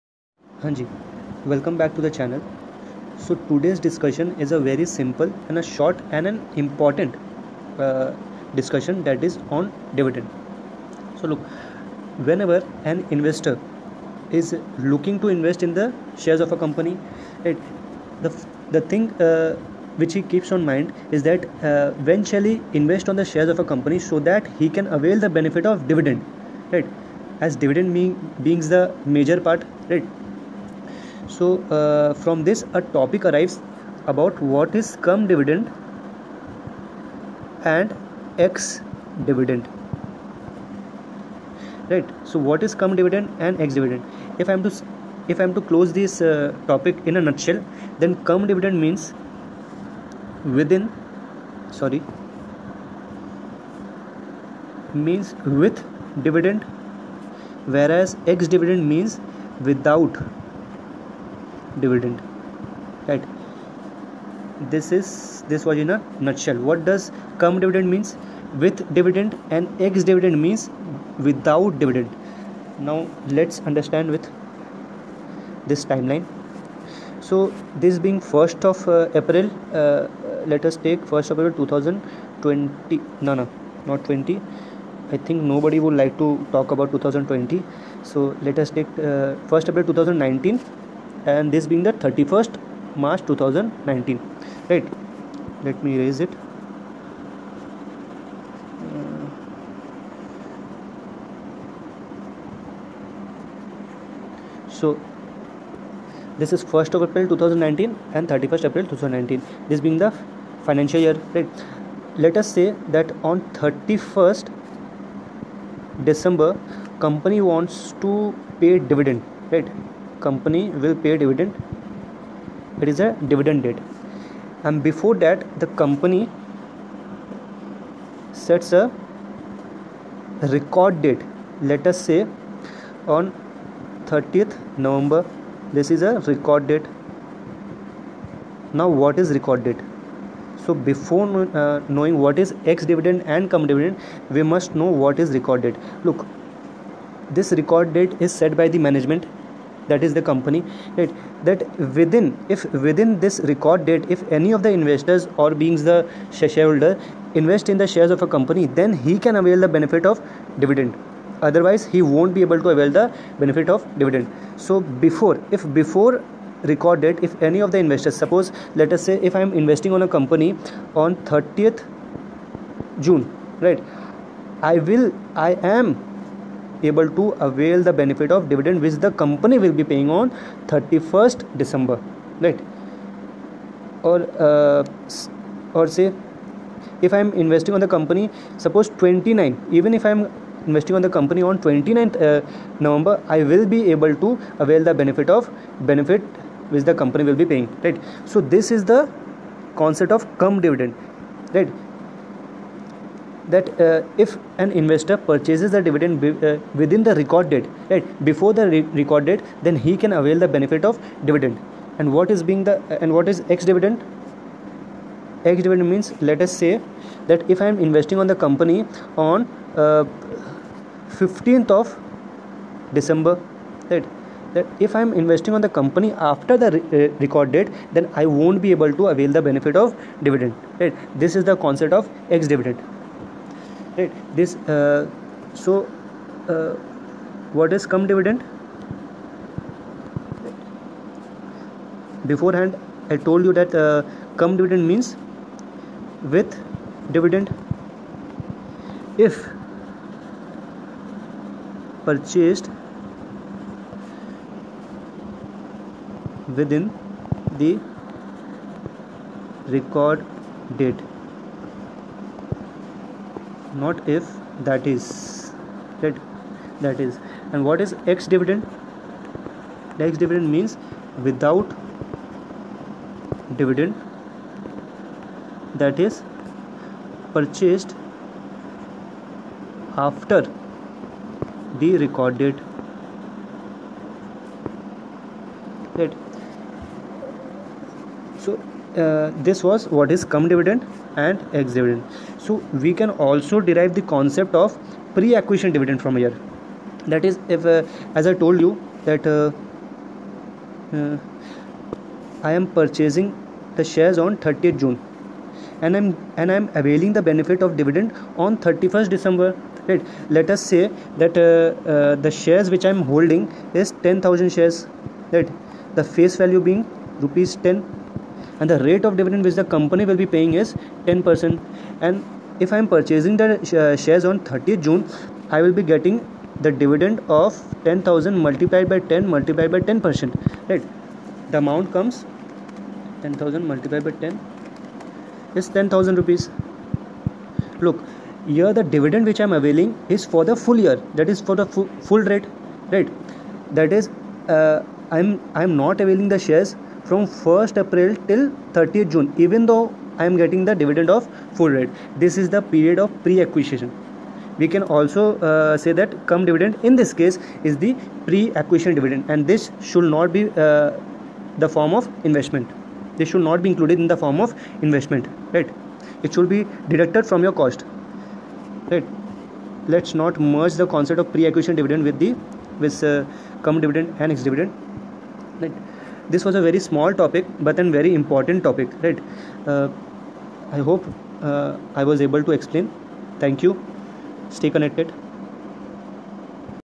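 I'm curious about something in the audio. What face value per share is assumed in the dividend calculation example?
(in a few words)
Rupees 10.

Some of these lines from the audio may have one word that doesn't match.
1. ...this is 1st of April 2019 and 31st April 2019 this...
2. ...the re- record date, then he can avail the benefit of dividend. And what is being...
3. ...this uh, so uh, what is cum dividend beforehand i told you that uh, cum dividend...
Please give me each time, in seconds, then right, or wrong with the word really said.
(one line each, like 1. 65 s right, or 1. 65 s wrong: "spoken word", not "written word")
1. 106 s right
2. 208 s right
3. 234 s right.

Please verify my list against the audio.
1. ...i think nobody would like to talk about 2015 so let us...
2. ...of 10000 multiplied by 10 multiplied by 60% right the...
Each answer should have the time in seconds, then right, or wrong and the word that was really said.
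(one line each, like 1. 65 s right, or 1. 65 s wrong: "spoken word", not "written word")
1. 85 s wrong: "2020", not "2015"
2. 327 s wrong: "10", not "60".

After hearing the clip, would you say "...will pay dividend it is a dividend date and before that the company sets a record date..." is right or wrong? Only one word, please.
right.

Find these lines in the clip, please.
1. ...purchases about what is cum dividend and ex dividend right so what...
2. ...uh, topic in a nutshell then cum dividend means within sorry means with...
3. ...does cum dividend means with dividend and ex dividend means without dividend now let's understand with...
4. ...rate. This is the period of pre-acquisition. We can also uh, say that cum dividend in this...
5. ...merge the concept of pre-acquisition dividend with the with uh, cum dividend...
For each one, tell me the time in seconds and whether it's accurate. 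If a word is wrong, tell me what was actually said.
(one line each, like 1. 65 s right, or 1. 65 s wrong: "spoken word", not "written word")
1. 33 s wrong: "arrives", not "purchases"
2. 46 s right
3. 66 s right
4. 351 s right
5. 370 s right.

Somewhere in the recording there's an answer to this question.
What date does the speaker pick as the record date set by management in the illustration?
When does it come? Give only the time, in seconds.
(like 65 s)
134 s.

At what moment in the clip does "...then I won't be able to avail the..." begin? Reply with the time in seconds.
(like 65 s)
227 s.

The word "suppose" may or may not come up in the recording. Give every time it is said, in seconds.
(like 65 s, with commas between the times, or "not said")
168 s, 188 s.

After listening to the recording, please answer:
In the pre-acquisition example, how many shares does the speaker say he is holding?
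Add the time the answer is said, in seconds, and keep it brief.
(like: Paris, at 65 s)
10000, at 314 s.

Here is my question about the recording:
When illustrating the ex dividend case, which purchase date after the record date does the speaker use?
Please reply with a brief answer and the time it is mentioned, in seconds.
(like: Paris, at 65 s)
15th December, at 221 s.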